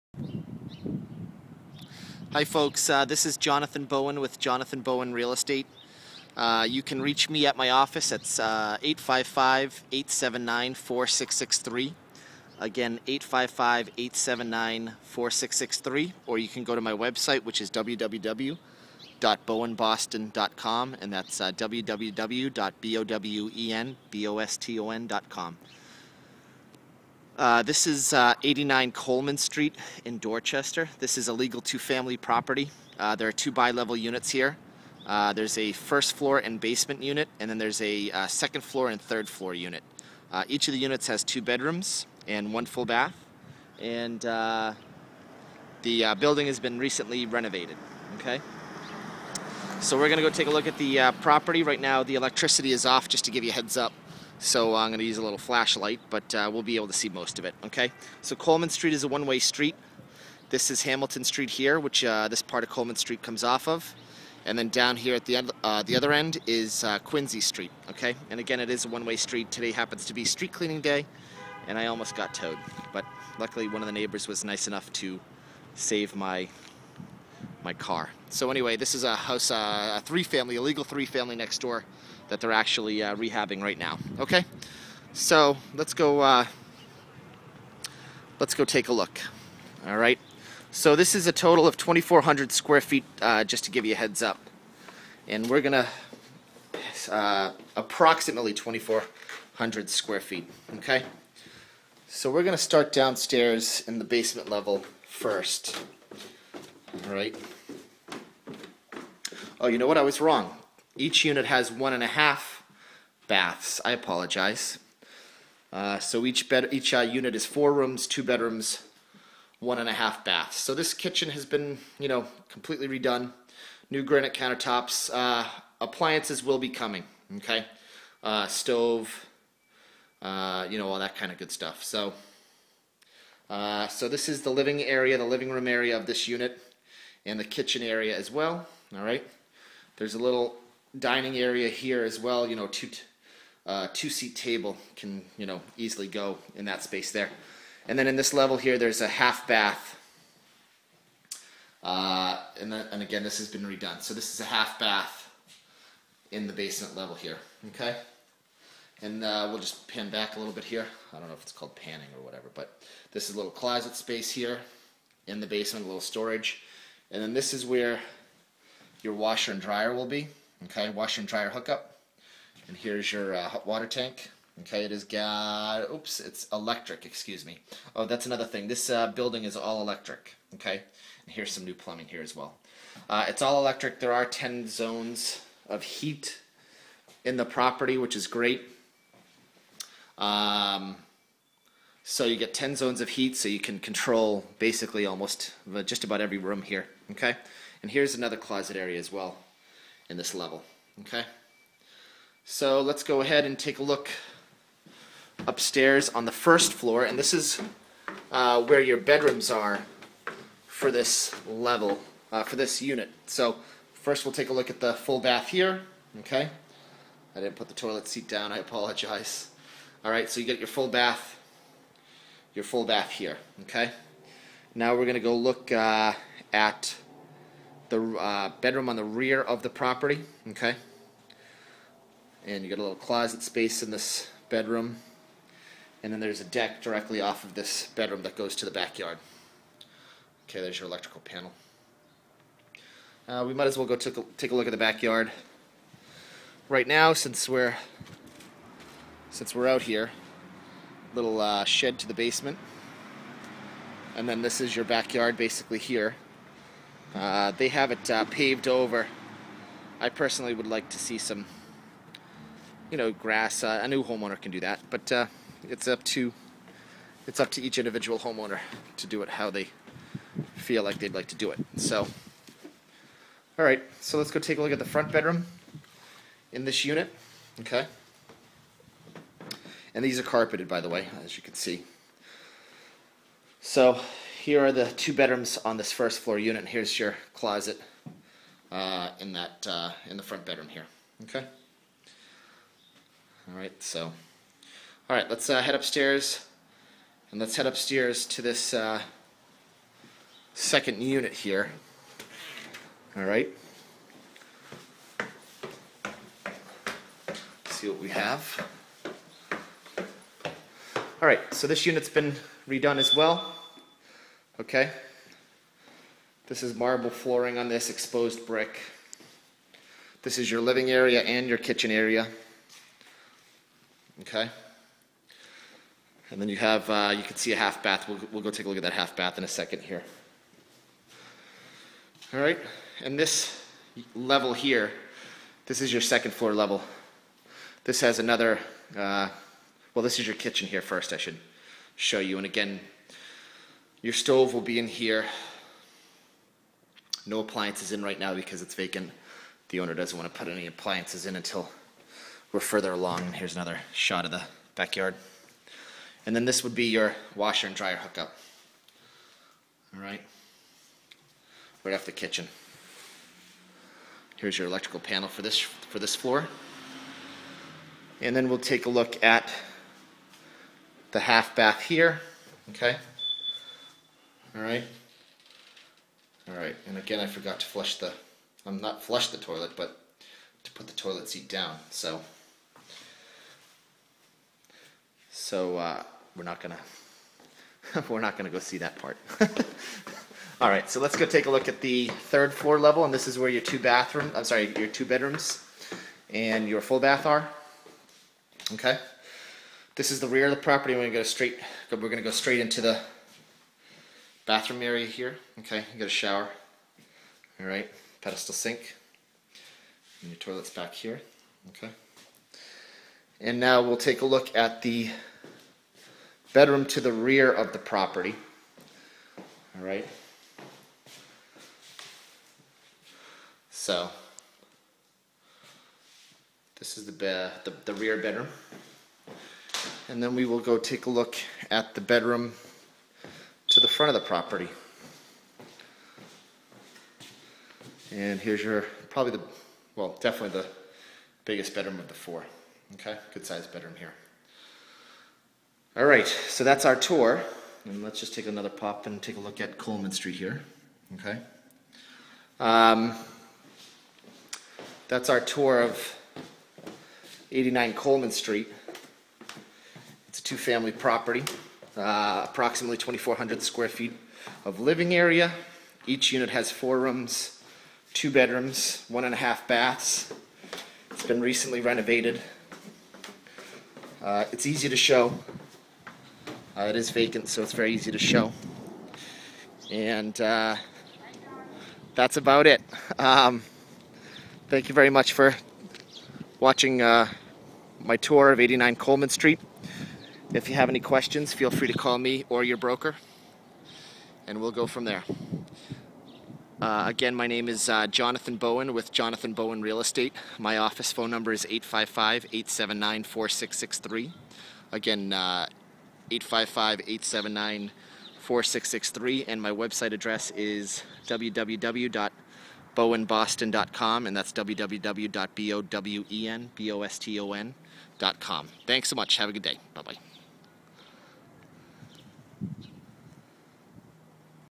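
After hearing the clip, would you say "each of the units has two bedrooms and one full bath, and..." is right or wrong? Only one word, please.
right.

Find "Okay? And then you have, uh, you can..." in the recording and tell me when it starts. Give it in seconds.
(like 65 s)
324 s.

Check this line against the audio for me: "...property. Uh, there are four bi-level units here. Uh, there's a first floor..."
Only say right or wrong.
wrong.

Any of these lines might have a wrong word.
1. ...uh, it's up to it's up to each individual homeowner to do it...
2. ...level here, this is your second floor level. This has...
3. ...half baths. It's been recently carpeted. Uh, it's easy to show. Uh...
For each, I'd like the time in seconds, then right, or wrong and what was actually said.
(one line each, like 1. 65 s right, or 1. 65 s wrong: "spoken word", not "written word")
1. 265 s right
2. 334 s right
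3. 469 s wrong: "renovated", not "carpeted".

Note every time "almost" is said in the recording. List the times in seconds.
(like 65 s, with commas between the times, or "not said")
71 s, 195 s.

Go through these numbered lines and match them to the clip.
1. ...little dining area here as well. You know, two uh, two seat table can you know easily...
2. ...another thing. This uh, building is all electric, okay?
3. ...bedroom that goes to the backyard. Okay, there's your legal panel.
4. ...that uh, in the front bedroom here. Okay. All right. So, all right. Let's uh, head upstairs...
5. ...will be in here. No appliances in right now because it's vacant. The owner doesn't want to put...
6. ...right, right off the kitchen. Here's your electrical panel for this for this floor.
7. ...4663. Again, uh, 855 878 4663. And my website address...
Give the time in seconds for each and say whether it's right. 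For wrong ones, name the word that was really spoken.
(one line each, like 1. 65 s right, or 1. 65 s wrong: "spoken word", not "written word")
1. 140 s right
2. 178 s right
3. 237 s wrong: "electrical", not "legal"
4. 289 s right
5. 344 s right
6. 360 s right
7. 503 s wrong: "879", not "878".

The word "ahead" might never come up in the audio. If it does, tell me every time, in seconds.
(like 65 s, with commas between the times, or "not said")
203 s.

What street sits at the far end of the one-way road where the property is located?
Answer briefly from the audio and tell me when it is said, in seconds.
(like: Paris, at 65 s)
Quincy Street, at 66 s.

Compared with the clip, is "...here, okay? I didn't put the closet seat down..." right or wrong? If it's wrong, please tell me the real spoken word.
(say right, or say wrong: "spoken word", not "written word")
wrong: "toilet", not "closet".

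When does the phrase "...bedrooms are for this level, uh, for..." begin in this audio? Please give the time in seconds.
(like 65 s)
208 s.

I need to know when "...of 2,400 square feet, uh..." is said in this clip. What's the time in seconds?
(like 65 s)
91 s.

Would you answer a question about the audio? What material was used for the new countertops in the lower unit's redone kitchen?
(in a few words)
granite.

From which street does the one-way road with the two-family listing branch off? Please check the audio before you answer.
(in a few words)
Hamilton Street.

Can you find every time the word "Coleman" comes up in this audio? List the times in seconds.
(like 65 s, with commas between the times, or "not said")
28 s, 58 s, 62 s, 449 s, 457 s, 488 s.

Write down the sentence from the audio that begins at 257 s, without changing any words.
Uh, they have it uh, paved over.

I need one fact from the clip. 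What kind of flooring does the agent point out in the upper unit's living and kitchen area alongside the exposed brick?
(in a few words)
marble.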